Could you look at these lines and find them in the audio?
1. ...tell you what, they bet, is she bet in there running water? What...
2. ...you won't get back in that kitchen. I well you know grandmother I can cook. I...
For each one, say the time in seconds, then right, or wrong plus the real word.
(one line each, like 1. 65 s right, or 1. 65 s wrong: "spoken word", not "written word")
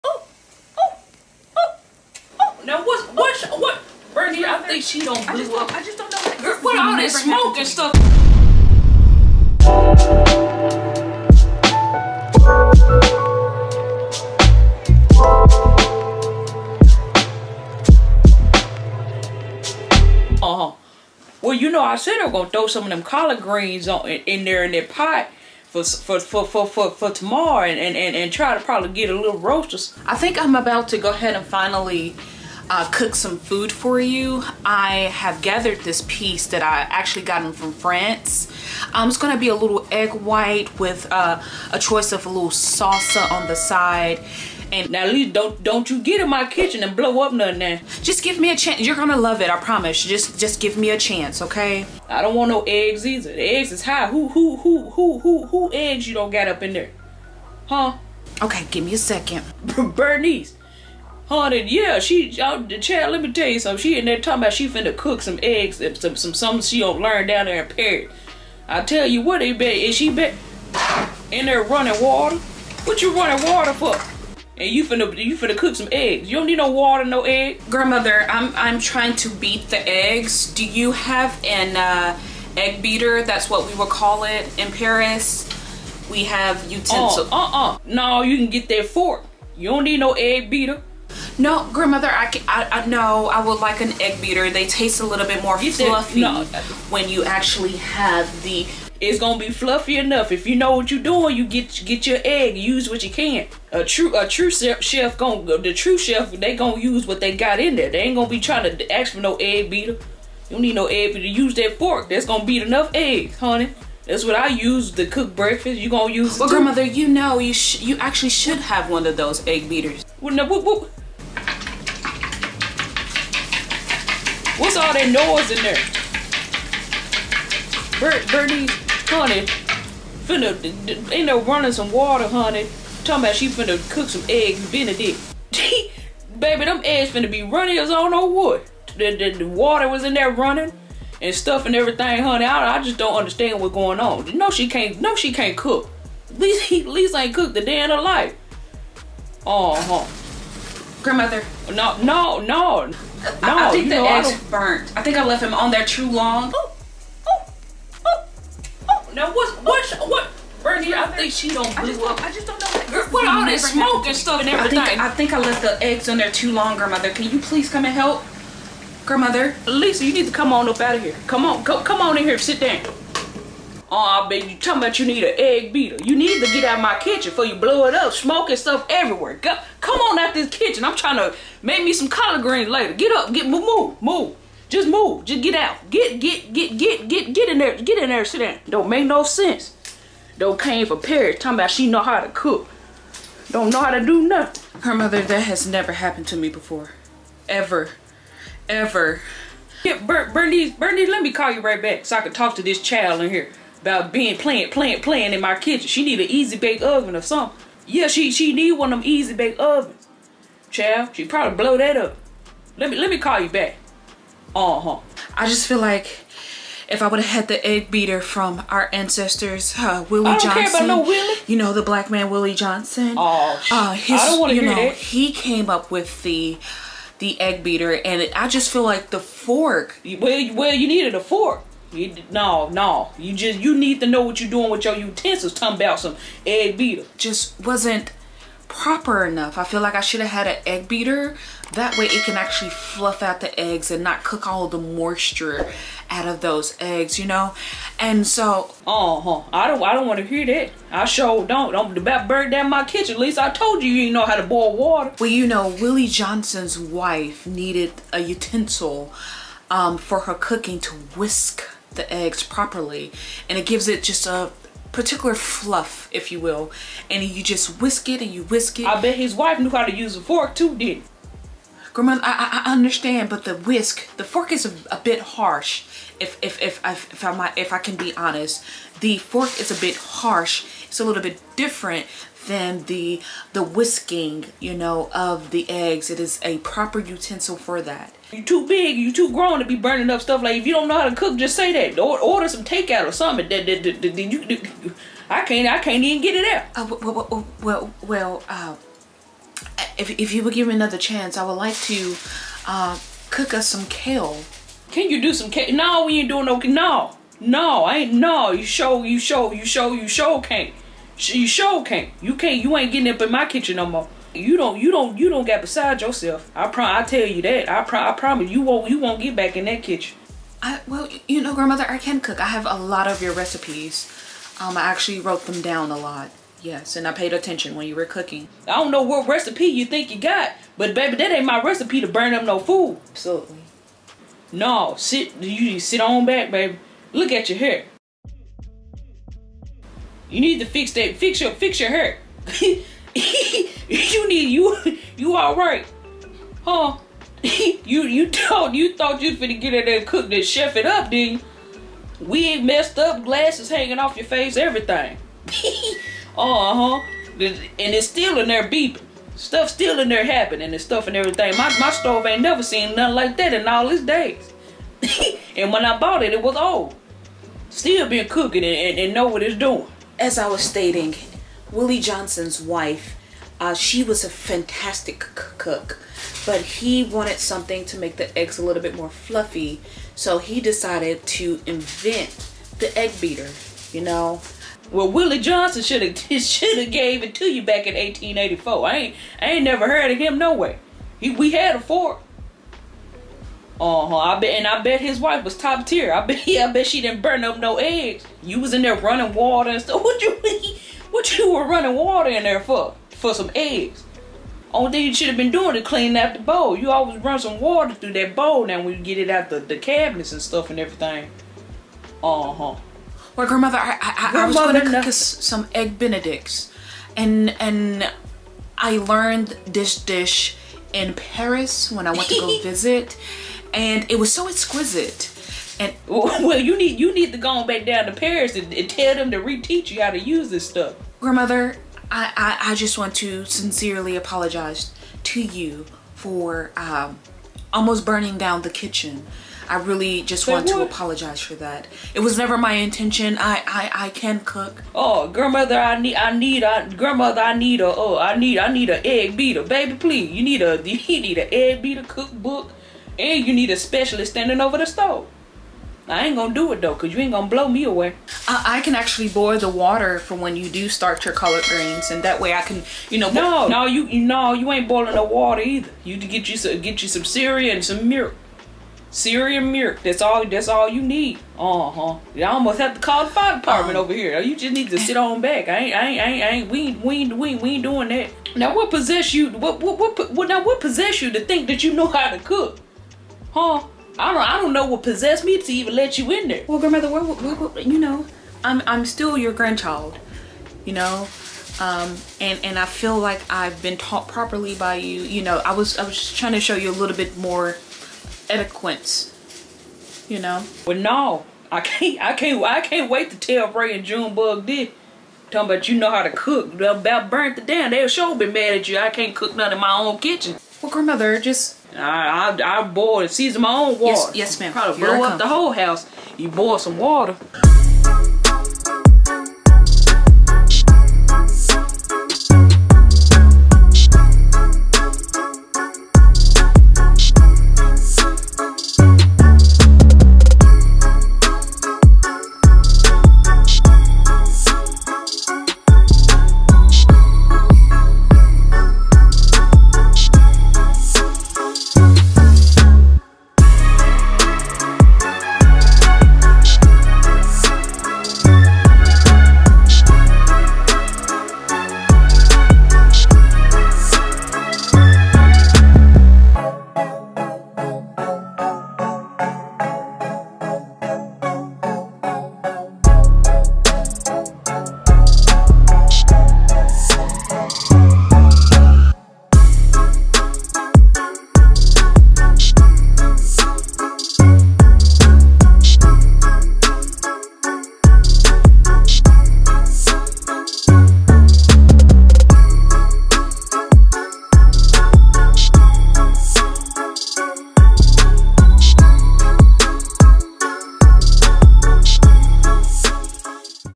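1. 68 s right
2. 318 s right.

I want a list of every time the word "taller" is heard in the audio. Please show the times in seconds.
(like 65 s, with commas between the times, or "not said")
not said.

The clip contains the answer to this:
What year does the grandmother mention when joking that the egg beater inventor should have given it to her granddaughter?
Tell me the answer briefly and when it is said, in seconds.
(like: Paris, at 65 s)
1884, at 387 s.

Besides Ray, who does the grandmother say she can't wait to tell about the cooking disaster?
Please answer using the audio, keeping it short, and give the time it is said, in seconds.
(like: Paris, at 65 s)
Junebug, at 504 s.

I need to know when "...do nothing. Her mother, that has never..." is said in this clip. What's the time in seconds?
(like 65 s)
194 s.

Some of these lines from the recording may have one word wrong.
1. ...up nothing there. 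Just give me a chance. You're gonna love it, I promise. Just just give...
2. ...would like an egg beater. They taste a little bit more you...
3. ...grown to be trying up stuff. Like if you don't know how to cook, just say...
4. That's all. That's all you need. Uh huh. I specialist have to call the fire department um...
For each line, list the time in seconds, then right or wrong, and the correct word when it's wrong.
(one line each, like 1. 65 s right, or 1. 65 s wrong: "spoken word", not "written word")
1. 47 s right
2. 93 s right
3. 289 s wrong: "burning", not "trying"
4. 470 s wrong: "almost", not "specialist".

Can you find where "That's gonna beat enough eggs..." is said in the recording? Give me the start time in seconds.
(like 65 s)
112 s.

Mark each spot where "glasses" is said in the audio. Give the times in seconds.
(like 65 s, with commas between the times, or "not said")
353 s.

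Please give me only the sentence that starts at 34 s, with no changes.
I have gathered this piece that I actually gotten from France.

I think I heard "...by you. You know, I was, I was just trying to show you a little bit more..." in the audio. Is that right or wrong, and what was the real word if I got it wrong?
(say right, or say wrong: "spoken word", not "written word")
right.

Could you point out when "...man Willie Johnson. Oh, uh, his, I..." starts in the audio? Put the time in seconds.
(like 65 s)
222 s.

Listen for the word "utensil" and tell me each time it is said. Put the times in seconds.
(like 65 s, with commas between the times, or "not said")
86 s, 234 s, 258 s, 286 s.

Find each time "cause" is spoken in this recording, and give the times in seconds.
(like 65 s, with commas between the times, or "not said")
456 s.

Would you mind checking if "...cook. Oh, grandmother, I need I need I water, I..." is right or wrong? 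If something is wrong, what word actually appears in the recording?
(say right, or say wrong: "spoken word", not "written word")
wrong: "grandmother", not "water".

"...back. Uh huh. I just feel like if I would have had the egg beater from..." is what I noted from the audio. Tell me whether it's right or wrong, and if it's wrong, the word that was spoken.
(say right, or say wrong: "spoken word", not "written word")
right.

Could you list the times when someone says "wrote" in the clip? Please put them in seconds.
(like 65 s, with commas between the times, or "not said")
325 s.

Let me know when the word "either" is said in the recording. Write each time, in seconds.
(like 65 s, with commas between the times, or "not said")
53 s, 465 s.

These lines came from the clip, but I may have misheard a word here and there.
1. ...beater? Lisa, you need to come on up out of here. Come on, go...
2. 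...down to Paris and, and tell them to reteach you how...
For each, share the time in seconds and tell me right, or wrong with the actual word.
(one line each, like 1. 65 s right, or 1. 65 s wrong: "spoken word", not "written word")
1. 169 s wrong: "grandmother", not "beater"
2. 427 s right.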